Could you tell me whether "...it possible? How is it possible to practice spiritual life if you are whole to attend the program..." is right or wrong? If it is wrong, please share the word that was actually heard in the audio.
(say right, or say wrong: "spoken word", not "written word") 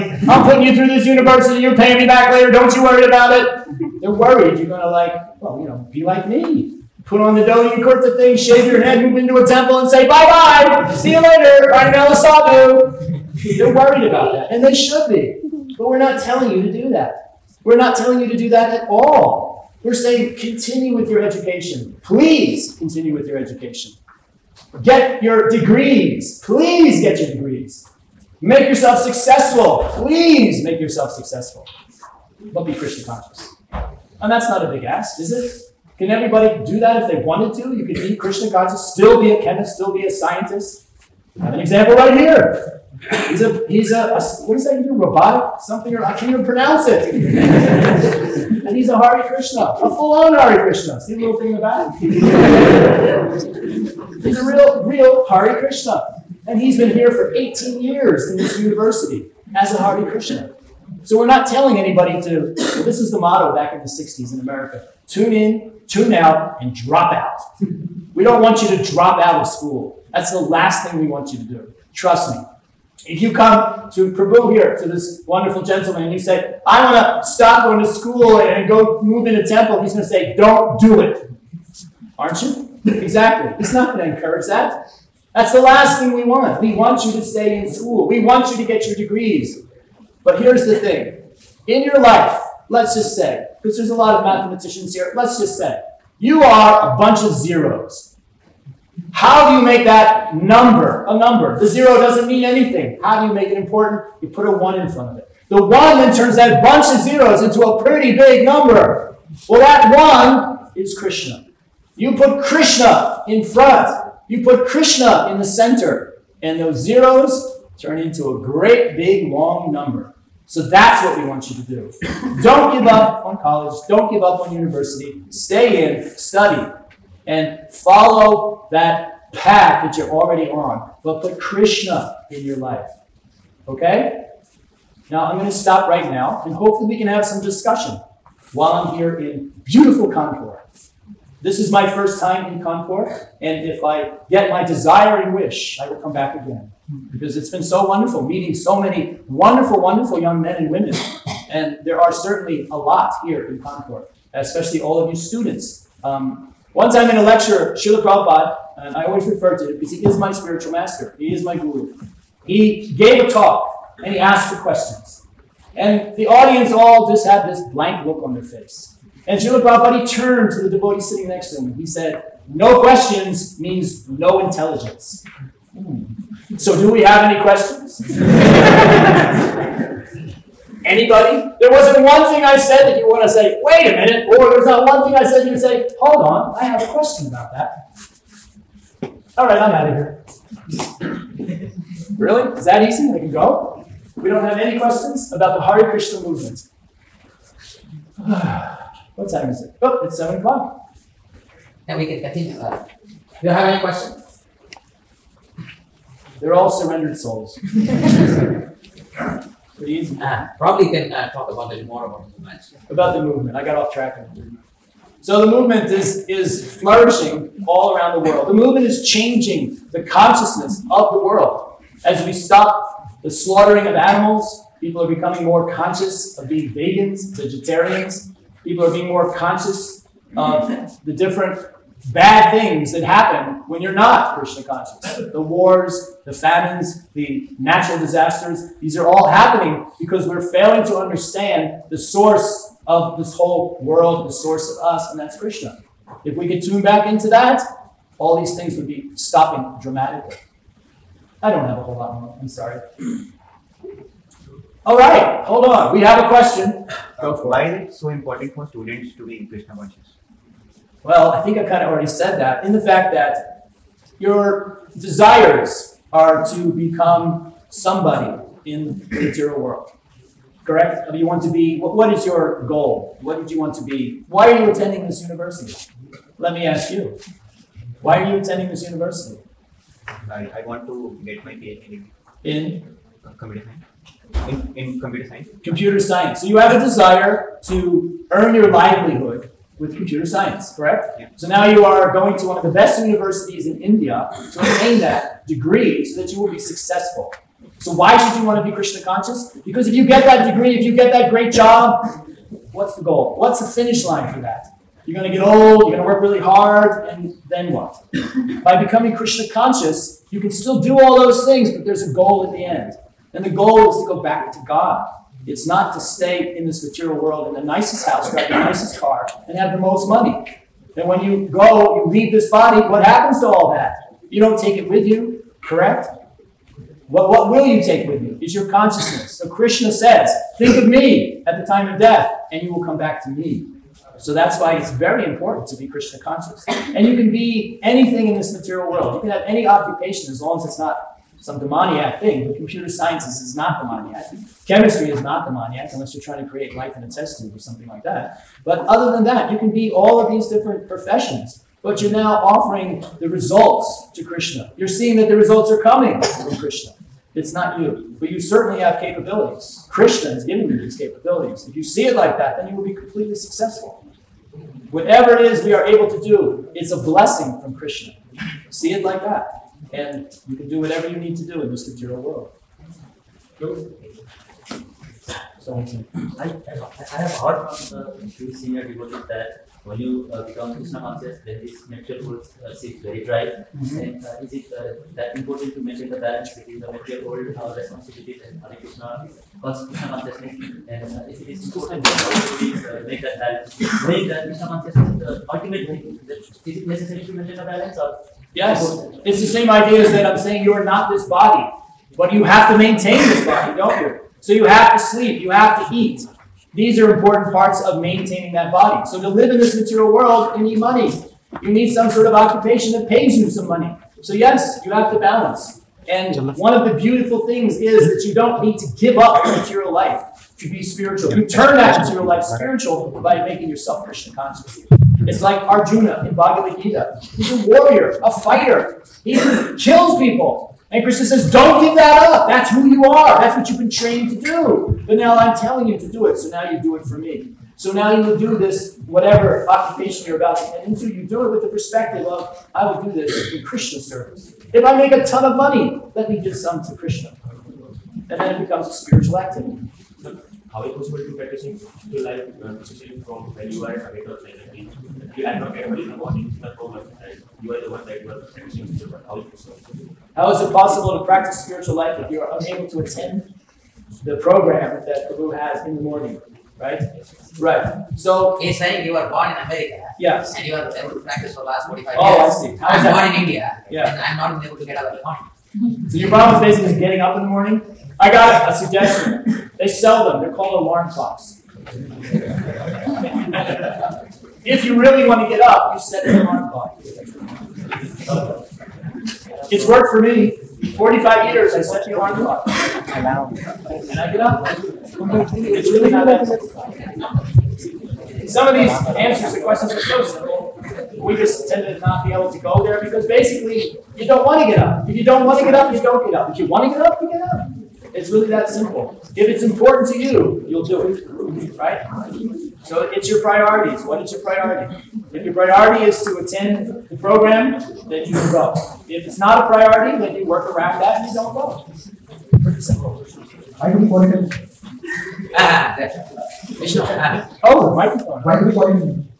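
wrong: "unable", not "whole".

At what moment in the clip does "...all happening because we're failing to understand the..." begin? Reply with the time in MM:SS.
03:59.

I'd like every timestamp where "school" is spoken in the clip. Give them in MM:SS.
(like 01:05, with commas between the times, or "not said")
01:09, 01:17, 01:27.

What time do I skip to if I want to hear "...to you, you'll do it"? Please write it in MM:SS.
08:30.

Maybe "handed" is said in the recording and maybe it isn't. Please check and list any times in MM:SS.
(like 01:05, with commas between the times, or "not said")
not said.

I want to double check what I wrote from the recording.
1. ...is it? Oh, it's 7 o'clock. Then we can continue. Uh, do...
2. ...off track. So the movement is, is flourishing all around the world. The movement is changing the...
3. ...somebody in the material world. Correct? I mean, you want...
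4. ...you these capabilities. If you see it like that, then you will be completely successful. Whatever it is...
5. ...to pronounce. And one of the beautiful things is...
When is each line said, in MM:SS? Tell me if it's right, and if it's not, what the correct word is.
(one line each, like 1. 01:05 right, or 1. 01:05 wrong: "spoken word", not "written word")
1. 03:19 right
2. 03:33 right
3. 04:27 right
4. 06:00 right
5. 06:55 wrong: "balance", not "pronounce".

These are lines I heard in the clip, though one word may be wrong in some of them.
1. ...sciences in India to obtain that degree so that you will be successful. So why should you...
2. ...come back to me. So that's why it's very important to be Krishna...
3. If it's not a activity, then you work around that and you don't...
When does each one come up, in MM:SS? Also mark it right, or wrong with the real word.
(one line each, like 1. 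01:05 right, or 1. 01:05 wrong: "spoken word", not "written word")
1. 04:53 wrong: "universities", not "sciences"
2. 05:32 right
3. 08:39 wrong: "priority", not "activity".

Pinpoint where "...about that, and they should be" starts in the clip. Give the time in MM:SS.
00:14.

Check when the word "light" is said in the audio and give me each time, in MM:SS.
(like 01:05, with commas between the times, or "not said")
not said.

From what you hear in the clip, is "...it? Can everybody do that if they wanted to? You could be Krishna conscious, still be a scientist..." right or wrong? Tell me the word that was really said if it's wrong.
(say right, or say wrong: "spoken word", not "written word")
wrong: "chemist", not "scientist".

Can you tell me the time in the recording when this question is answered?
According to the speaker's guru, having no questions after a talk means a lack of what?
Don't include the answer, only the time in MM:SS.
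02:54.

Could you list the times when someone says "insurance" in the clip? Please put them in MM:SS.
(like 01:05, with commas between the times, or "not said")
not said.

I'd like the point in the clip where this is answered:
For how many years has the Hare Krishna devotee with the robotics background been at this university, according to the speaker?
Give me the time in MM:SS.
00:57.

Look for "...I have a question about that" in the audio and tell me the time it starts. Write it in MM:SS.
03:06.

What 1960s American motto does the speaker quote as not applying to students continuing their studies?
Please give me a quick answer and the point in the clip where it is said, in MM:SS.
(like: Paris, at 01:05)
tune in, tune out, and drop out, at 01:05.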